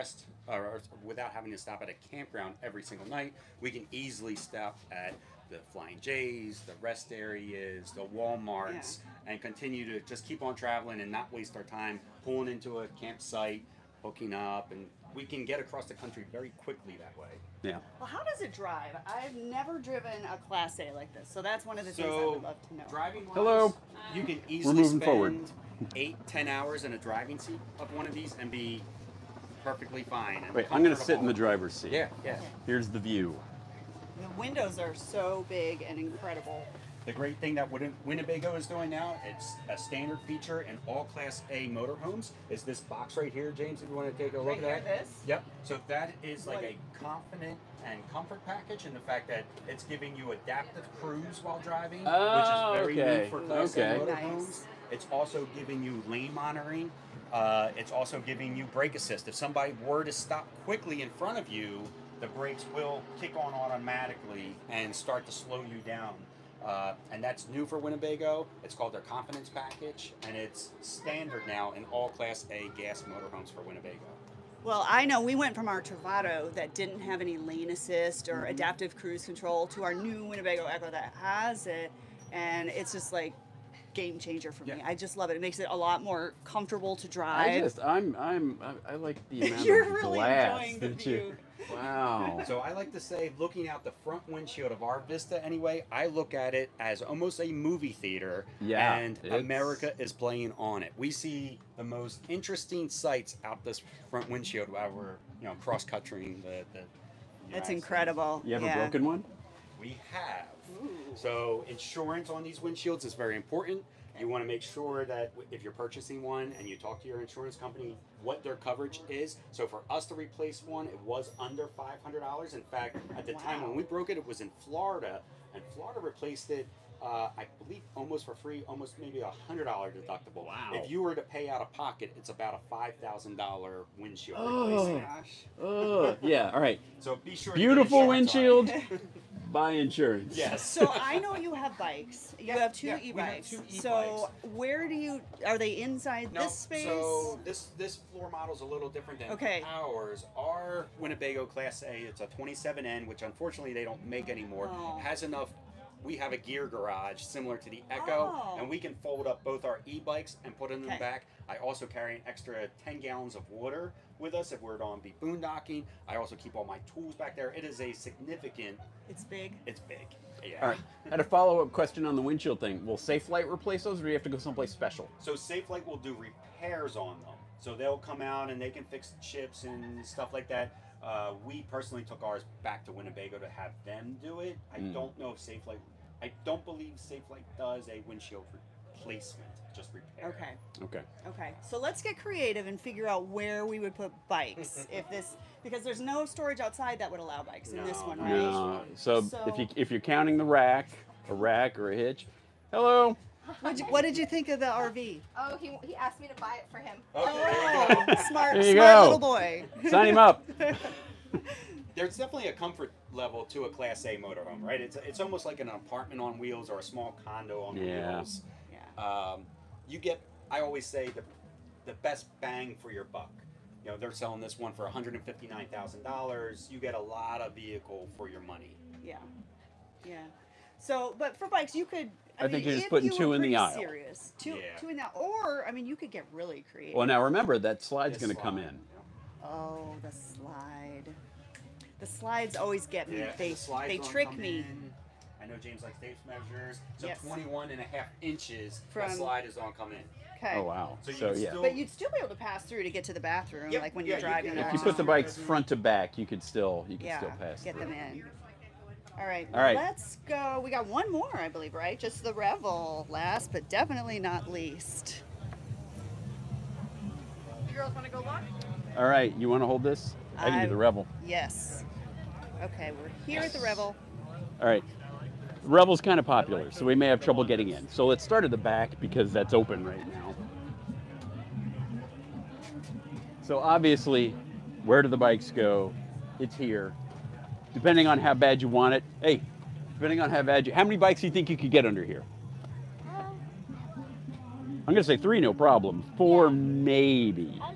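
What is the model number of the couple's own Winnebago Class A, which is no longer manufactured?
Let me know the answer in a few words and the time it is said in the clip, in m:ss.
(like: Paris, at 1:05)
27N, at 2:32.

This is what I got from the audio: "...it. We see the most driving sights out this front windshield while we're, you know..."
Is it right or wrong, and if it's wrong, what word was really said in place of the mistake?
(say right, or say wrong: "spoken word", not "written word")
wrong: "interesting", not "driving".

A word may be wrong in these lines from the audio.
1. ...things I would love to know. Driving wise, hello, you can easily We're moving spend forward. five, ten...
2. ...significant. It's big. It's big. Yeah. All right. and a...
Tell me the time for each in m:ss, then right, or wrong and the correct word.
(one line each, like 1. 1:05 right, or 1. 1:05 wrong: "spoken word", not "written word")
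1. 0:22 wrong: "eight", not "five"
2. 2:47 right.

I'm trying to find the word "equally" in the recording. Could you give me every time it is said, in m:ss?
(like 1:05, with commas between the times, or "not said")
not said.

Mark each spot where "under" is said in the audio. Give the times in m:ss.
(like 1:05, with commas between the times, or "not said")
2:01, 4:51.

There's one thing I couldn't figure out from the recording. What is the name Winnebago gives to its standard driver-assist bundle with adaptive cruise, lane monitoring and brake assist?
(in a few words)
Confidence Package.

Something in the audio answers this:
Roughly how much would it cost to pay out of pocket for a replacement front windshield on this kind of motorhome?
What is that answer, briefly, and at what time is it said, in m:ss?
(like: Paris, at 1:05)
$5,000, at 2:12.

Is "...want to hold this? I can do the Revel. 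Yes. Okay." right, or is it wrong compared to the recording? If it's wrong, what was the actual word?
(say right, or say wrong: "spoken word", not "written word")
right.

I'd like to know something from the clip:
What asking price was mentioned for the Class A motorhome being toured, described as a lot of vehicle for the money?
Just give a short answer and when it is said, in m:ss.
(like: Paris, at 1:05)
$159,000, at 3:44.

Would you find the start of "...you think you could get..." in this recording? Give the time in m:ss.
4:51.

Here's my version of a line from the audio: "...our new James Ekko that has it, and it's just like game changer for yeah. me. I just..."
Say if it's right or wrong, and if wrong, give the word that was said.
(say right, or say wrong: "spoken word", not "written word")
wrong: "Winnebago", not "James".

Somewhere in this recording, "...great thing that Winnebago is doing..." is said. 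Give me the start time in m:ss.
0:37.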